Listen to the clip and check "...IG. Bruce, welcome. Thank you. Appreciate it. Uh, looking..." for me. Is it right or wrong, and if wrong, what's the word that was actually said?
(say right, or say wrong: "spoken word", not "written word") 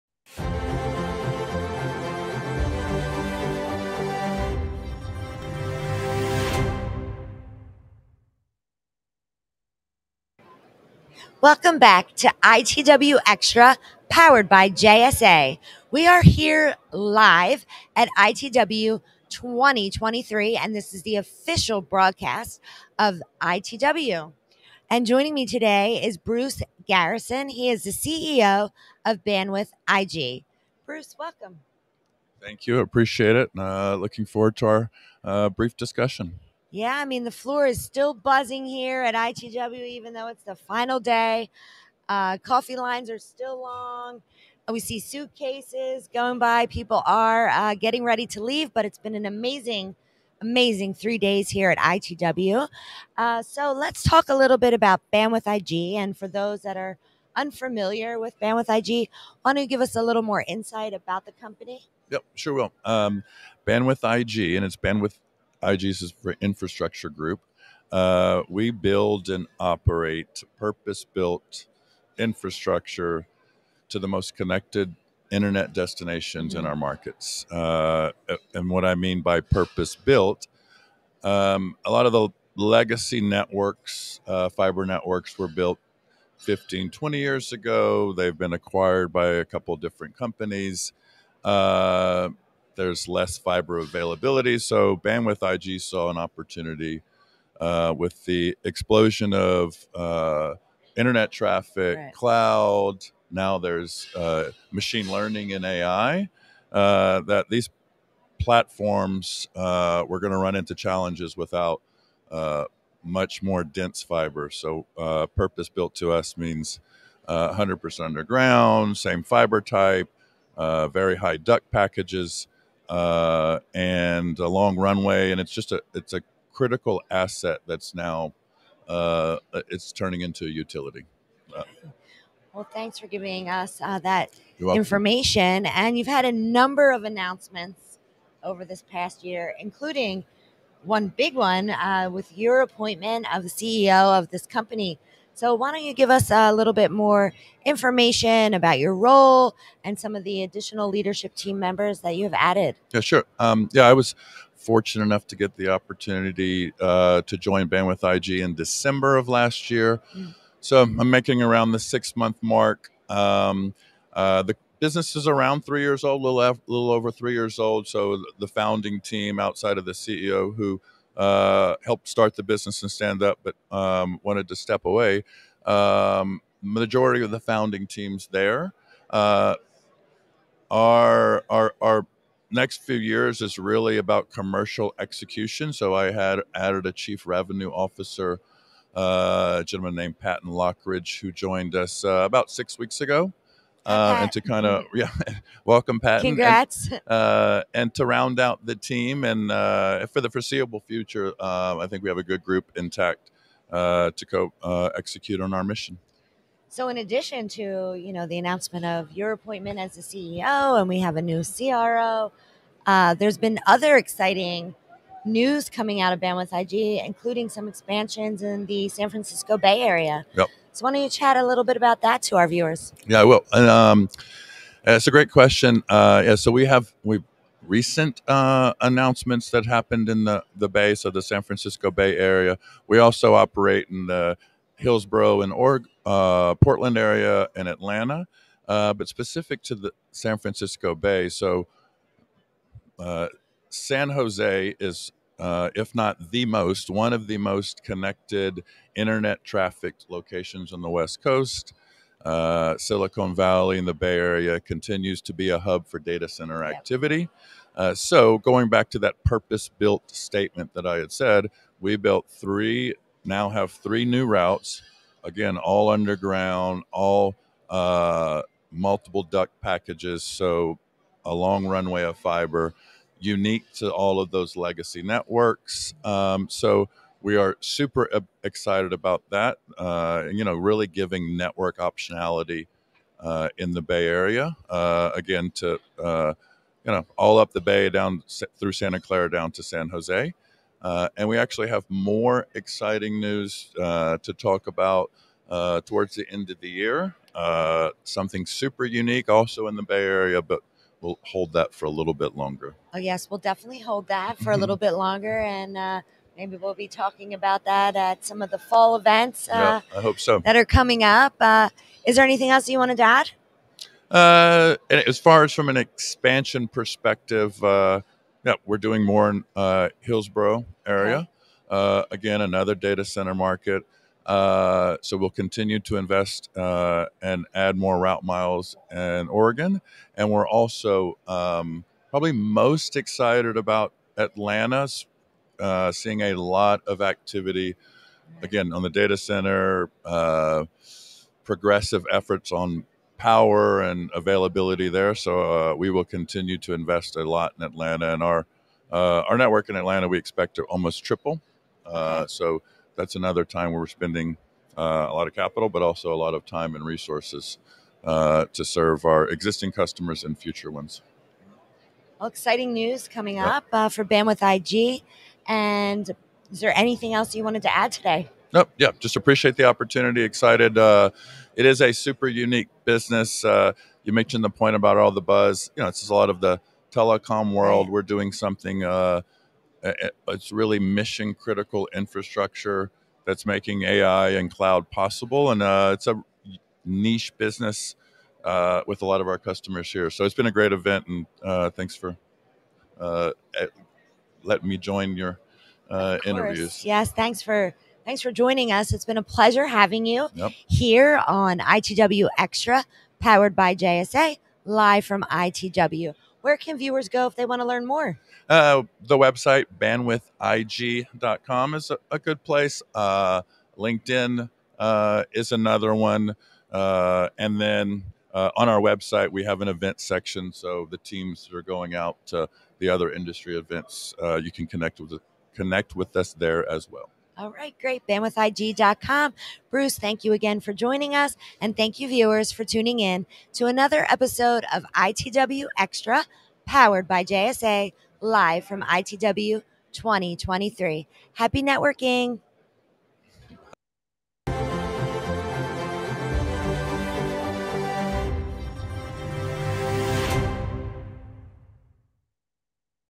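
right.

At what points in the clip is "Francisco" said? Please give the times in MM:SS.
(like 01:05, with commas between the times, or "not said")
03:39, 03:51, 04:00.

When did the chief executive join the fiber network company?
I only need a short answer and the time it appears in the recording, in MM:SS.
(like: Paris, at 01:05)
December of last year, at 02:38.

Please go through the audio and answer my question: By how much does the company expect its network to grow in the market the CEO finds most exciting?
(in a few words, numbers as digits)
Almost triple.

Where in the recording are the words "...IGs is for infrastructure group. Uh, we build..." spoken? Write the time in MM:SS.
01:05.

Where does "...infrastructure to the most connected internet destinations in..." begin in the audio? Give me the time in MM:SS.
01:12.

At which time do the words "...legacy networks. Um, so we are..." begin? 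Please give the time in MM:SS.
04:34.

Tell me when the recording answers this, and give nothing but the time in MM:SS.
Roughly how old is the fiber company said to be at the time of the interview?
02:45.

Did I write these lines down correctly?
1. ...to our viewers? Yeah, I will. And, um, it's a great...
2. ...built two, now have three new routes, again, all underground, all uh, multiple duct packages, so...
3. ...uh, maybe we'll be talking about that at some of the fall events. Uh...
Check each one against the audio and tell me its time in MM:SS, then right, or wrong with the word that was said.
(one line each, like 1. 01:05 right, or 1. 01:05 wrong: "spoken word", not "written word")
1. 03:42 right
2. 04:21 wrong: "three", not "two"
3. 05:05 right.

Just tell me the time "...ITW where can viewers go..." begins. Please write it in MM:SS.
06:45.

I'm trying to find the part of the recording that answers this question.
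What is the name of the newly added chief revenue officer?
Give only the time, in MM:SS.
03:10.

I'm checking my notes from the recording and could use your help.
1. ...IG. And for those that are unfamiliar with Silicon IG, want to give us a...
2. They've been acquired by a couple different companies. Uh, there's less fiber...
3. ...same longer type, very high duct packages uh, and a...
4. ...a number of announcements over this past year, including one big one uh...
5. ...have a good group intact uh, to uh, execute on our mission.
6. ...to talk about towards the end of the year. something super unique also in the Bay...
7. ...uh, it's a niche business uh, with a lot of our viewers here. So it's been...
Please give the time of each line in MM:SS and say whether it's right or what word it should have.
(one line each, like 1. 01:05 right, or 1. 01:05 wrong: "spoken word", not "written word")
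1. 00:55 wrong: "Bandwidth", not "Silicon"
2. 01:28 right
3. 01:58 wrong: "fiber", not "longer"
4. 02:16 right
5. 03:22 right
6. 04:54 right
7. 06:25 wrong: "customers", not "viewers".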